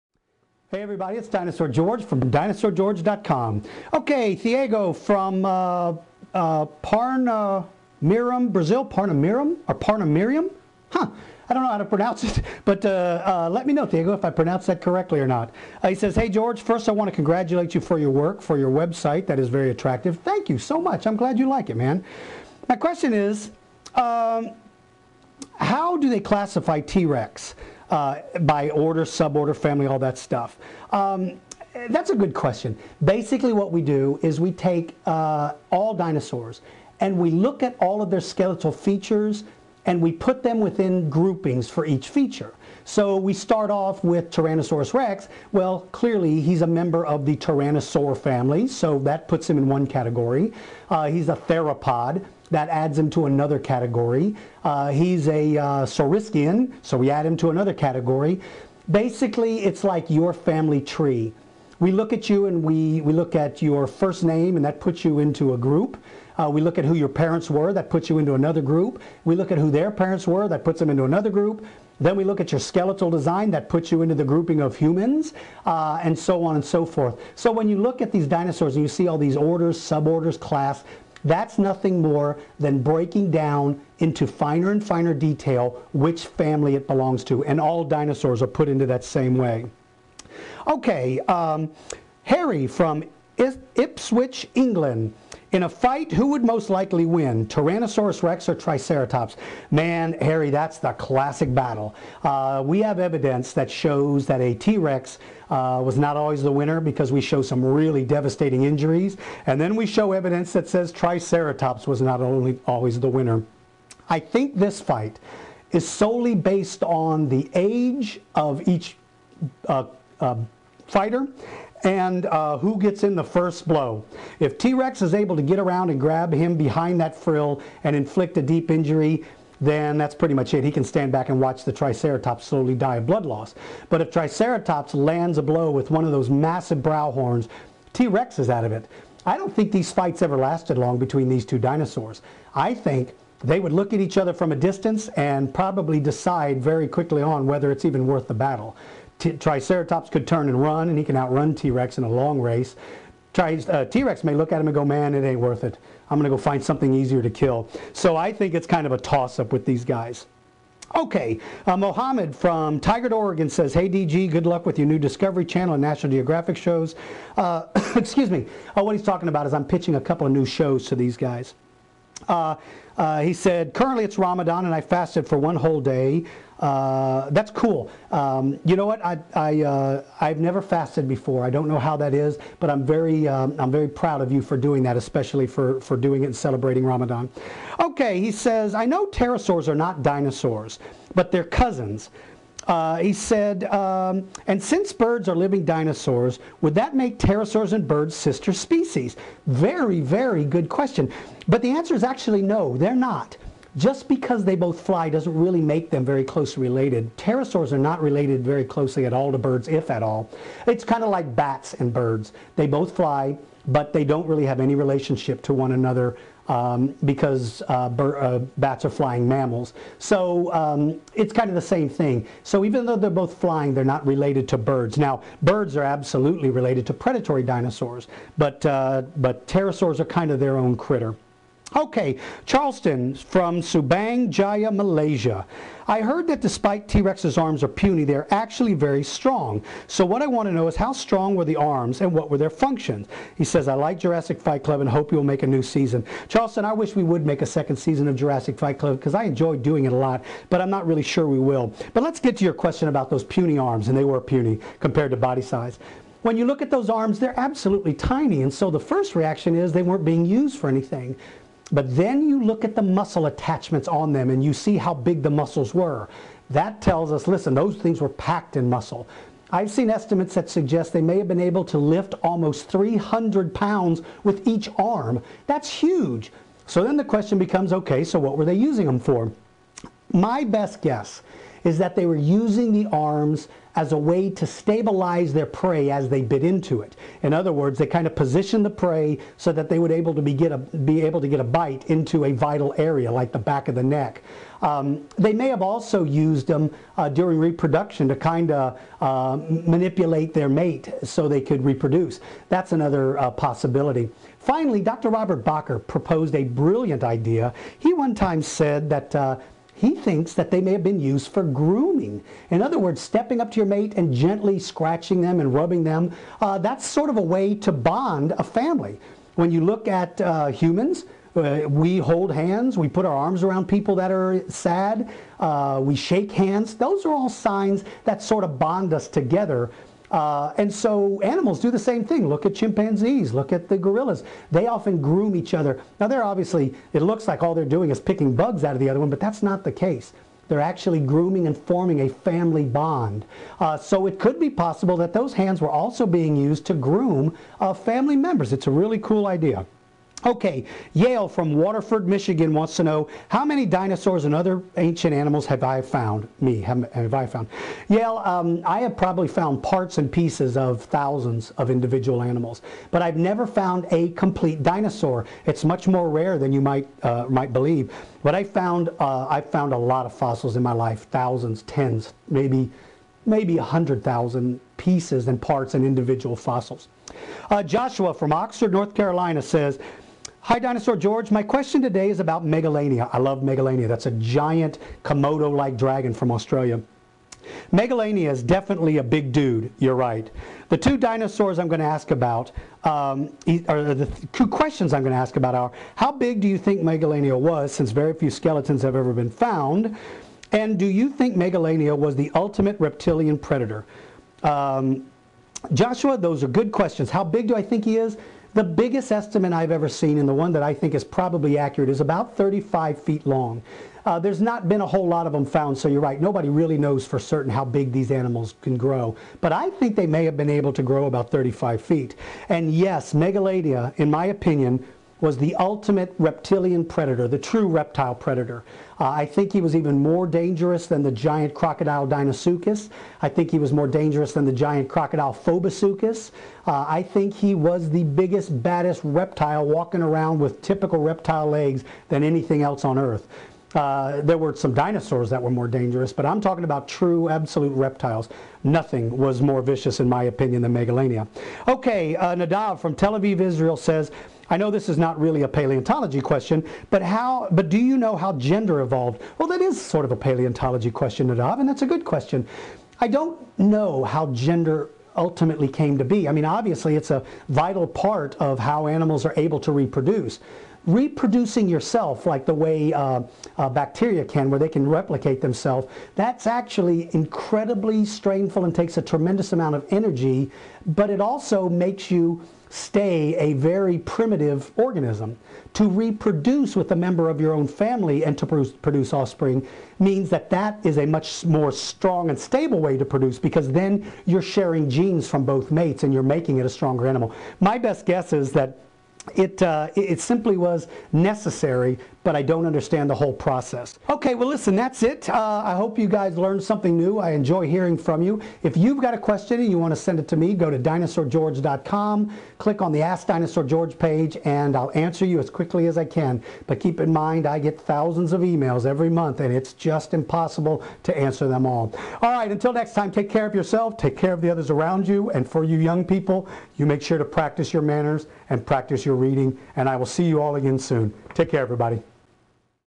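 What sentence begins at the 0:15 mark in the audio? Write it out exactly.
Uh, he says, hey George, first I want to congratulate you for your work, for your website, that is very attractive.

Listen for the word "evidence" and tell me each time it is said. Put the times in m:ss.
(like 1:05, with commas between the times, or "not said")
1:42, 1:50.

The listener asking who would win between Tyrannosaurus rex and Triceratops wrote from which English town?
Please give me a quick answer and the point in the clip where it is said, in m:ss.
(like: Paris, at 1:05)
Ipswich, at 1:33.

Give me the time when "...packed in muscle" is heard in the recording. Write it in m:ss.
4:28.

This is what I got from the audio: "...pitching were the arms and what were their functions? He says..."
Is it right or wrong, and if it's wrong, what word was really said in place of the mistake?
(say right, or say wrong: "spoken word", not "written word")
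wrong: "strong", not "pitching".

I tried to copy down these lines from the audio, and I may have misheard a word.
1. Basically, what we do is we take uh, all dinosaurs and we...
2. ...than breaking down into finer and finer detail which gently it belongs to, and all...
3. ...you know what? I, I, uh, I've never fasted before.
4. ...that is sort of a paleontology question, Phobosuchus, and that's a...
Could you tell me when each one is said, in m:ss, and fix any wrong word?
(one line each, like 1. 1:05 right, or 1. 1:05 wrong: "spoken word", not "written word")
1. 0:33 right
2. 1:22 wrong: "family", not "gently"
3. 2:58 right
4. 7:39 wrong: "Nadav", not "Phobosuchus".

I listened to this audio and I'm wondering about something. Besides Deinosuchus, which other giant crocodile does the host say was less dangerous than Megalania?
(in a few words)
Phobosuchus.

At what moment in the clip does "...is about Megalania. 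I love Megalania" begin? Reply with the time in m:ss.
6:22.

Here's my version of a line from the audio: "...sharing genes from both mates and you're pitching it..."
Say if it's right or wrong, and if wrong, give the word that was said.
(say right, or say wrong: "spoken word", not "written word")
wrong: "making", not "pitching".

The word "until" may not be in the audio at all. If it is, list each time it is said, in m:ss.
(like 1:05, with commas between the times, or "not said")
8:42.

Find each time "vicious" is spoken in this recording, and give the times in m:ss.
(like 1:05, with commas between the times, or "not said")
7:29.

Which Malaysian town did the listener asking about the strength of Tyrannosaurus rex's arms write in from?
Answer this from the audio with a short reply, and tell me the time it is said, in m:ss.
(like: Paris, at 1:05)
Subang Jaya, at 3:53.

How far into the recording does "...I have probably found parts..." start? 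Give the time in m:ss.
5:58.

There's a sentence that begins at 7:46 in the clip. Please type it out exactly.
I mean, obviously, it's a vital part of how animals are able to reproduce.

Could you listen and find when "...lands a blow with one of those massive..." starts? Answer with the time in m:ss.
2:14.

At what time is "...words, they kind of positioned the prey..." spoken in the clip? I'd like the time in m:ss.
4:47.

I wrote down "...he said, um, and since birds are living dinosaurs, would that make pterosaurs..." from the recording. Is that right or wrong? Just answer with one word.
right.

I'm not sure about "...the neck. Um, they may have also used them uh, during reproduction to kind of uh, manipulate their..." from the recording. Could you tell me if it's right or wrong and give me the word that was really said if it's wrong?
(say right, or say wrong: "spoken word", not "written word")
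right.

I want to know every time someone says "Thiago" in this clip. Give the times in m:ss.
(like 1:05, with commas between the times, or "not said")
0:04, 0:13.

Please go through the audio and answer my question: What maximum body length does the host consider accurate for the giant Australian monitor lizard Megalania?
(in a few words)
35 feet.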